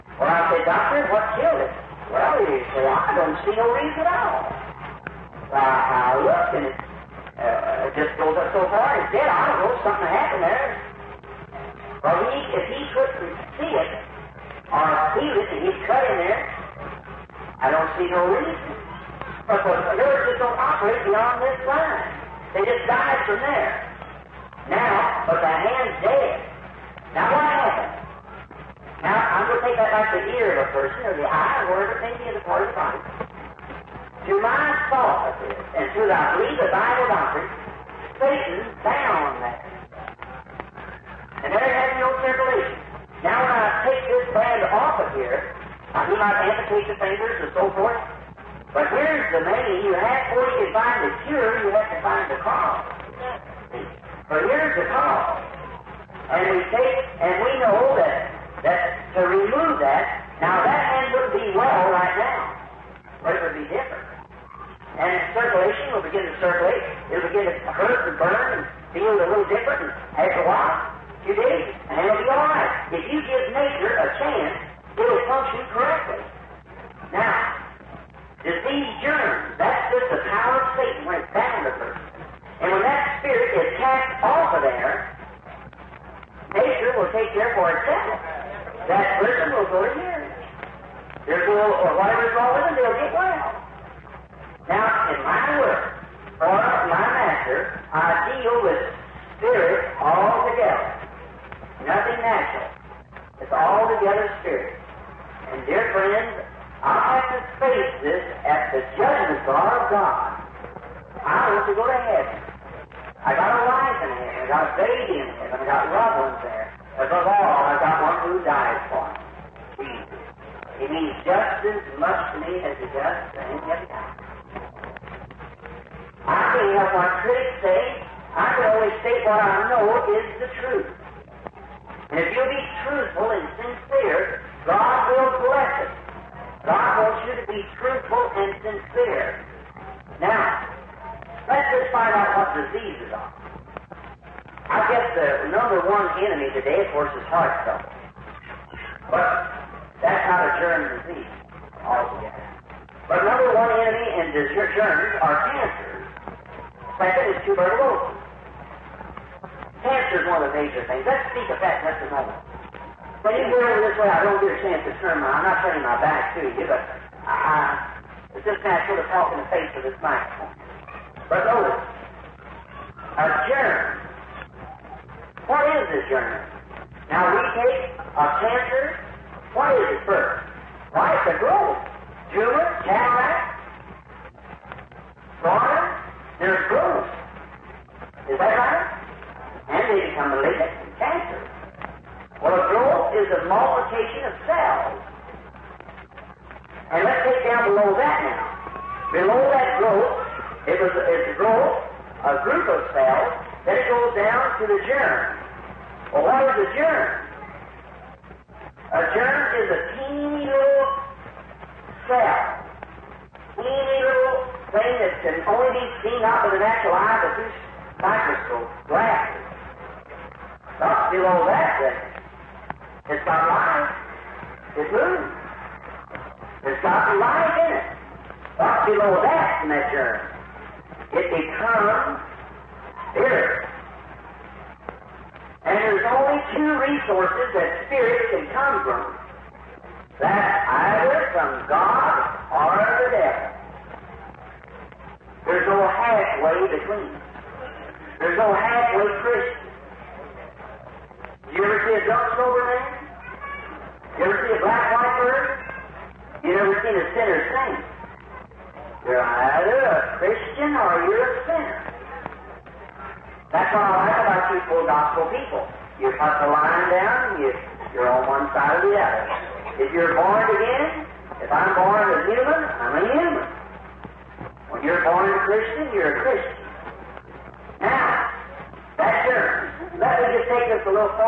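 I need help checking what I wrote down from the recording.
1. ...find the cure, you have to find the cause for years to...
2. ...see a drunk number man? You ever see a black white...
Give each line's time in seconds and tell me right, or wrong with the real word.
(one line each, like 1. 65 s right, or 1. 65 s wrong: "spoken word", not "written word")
1. 50 s right
2. 251 s wrong: "sober", not "number".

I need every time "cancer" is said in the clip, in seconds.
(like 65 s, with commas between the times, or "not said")
155 s, 159 s, 178 s, 190 s.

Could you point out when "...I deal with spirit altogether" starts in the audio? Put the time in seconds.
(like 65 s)
97 s.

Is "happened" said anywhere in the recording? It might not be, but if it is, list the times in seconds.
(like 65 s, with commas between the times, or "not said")
10 s, 27 s.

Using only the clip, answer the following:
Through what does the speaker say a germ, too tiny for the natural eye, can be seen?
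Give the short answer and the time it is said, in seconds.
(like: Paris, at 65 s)
microscope glasses, at 218 s.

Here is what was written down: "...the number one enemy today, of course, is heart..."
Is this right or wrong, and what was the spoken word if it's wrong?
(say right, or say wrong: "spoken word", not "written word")
right.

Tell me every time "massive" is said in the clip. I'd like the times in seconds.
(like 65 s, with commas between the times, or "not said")
not said.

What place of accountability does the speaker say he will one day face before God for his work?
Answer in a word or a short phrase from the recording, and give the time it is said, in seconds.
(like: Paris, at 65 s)
judgment bar, at 108 s.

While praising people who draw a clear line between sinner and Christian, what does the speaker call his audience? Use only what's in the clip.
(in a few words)
full gospel people.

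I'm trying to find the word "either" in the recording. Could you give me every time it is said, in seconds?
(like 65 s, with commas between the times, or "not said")
240 s, 259 s.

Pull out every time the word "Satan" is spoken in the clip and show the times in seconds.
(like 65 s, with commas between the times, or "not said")
38 s, 80 s.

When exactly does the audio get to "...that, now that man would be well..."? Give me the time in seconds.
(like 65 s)
59 s.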